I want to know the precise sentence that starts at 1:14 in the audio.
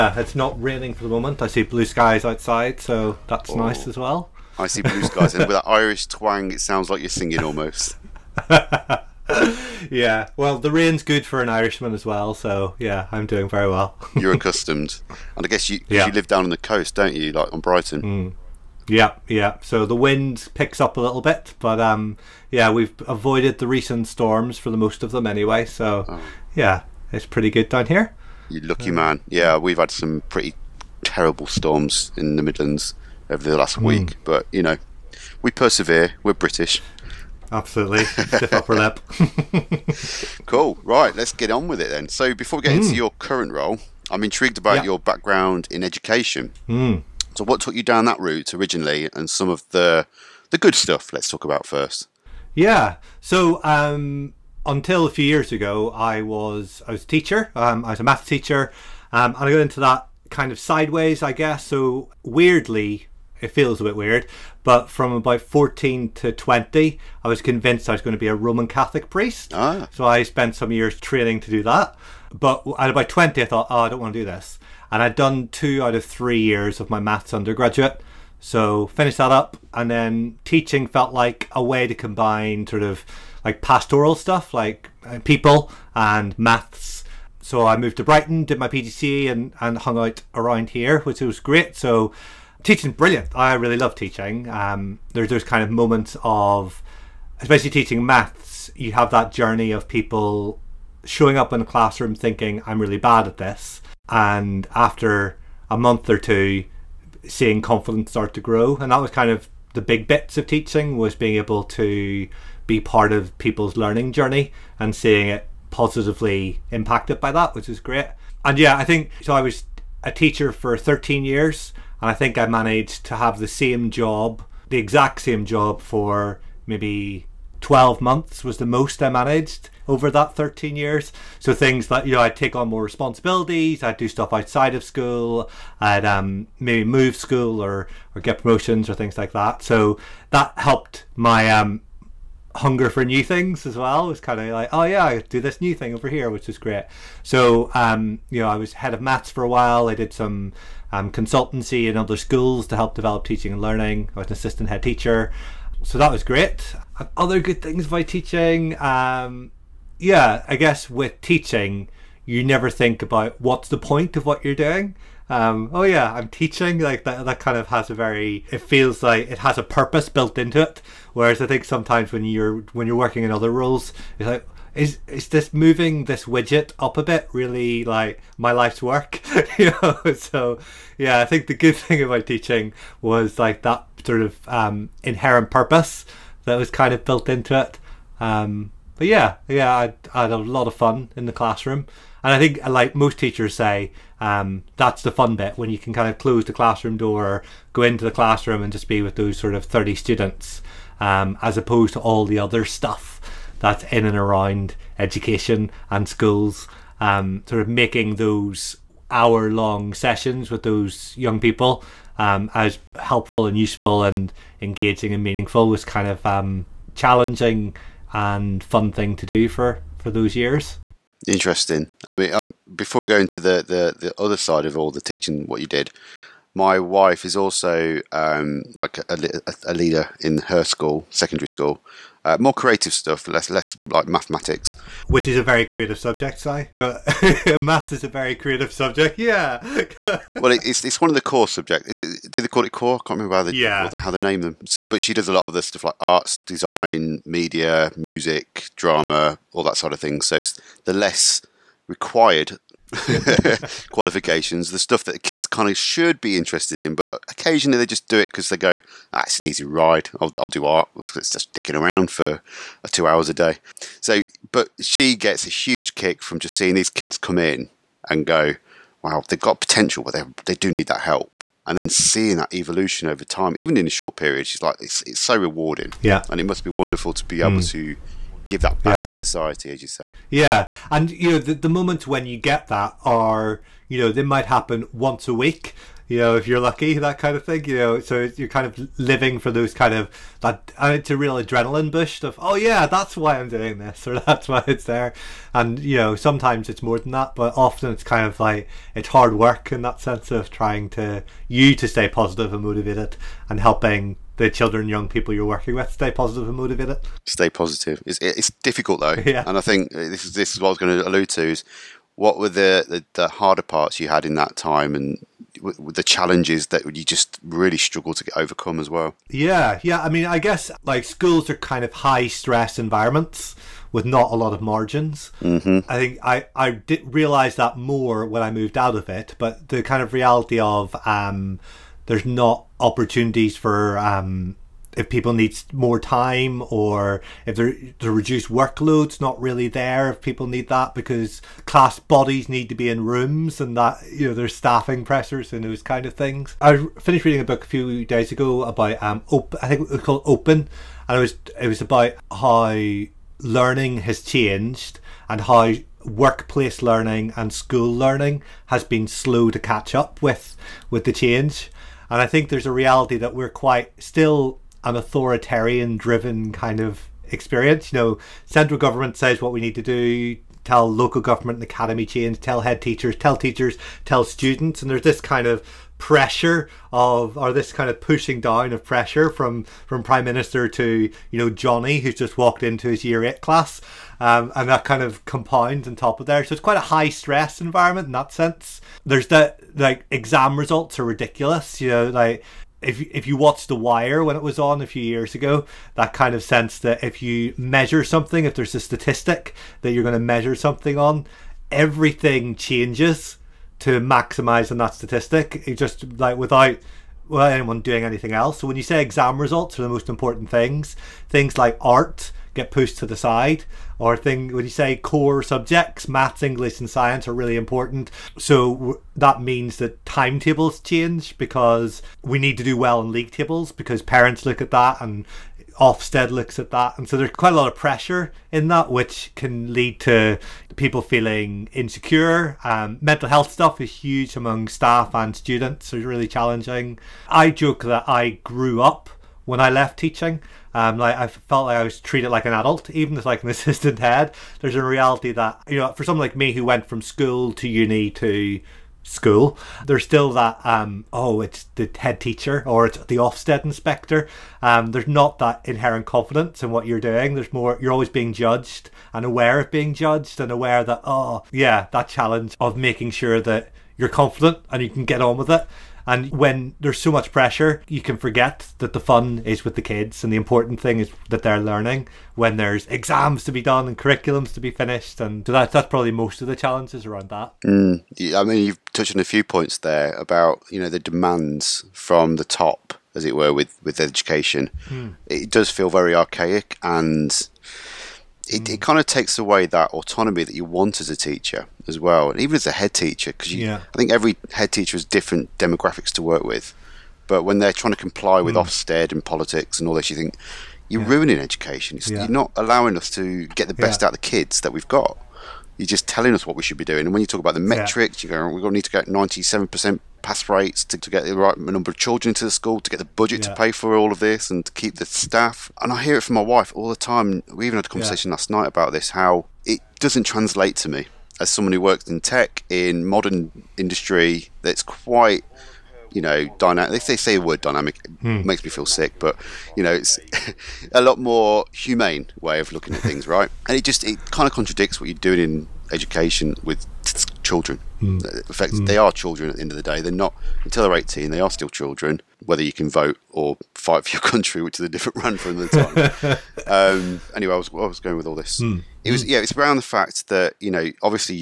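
And I'd done two out of three years of my maths undergraduate.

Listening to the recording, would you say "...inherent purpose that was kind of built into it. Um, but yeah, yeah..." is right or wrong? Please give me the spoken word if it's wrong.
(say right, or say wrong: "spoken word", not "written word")
right.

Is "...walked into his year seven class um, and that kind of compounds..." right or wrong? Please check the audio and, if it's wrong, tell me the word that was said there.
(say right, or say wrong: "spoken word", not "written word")
wrong: "eight", not "seven".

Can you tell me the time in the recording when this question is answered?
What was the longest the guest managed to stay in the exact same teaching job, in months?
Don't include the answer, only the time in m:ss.
2:07.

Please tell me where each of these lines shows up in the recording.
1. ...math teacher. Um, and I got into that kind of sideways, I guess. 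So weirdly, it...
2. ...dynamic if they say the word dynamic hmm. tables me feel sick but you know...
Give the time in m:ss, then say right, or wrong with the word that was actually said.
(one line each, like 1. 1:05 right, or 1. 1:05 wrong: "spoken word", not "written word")
1. 0:58 right
2. 8:46 wrong: "makes", not "tables".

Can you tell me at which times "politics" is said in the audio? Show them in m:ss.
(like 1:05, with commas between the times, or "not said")
8:19.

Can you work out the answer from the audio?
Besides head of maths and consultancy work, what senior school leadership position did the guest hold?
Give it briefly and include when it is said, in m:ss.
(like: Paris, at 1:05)
assistant head teacher, at 2:34.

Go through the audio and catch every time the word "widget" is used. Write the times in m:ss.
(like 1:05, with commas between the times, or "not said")
2:56.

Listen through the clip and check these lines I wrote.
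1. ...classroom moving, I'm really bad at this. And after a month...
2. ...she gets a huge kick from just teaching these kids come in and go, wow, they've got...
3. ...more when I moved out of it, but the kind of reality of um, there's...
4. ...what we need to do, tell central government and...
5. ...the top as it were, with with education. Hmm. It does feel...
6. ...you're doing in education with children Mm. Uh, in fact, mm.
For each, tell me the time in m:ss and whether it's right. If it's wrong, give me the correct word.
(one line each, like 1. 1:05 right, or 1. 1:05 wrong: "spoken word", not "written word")
1. 1:41 wrong: "thinking", not "moving"
2. 4:24 wrong: "seeing", not "teaching"
3. 5:27 right
4. 6:09 wrong: "local", not "central"
5. 8:02 right
6. 8:55 right.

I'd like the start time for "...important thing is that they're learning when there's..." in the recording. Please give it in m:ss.
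7:50.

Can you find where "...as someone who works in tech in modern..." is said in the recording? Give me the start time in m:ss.
8:41.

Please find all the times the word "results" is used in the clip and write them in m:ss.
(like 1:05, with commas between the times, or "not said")
6:30, 6:49.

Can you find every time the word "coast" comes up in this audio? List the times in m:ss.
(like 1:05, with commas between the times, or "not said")
0:16.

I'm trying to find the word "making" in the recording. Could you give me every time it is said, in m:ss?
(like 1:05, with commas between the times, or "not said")
3:27, 7:42.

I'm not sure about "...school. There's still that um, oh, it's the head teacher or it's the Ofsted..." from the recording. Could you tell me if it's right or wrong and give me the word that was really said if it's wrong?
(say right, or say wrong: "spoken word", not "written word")
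right.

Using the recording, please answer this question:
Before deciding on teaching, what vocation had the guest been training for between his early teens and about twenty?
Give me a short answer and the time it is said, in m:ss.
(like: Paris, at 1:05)
Roman Catholic priest, at 1:08.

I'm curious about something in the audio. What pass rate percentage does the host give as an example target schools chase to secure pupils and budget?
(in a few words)
97%.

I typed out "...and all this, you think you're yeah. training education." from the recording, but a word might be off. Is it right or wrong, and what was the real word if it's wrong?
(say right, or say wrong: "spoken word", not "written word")
wrong: "ruining", not "training".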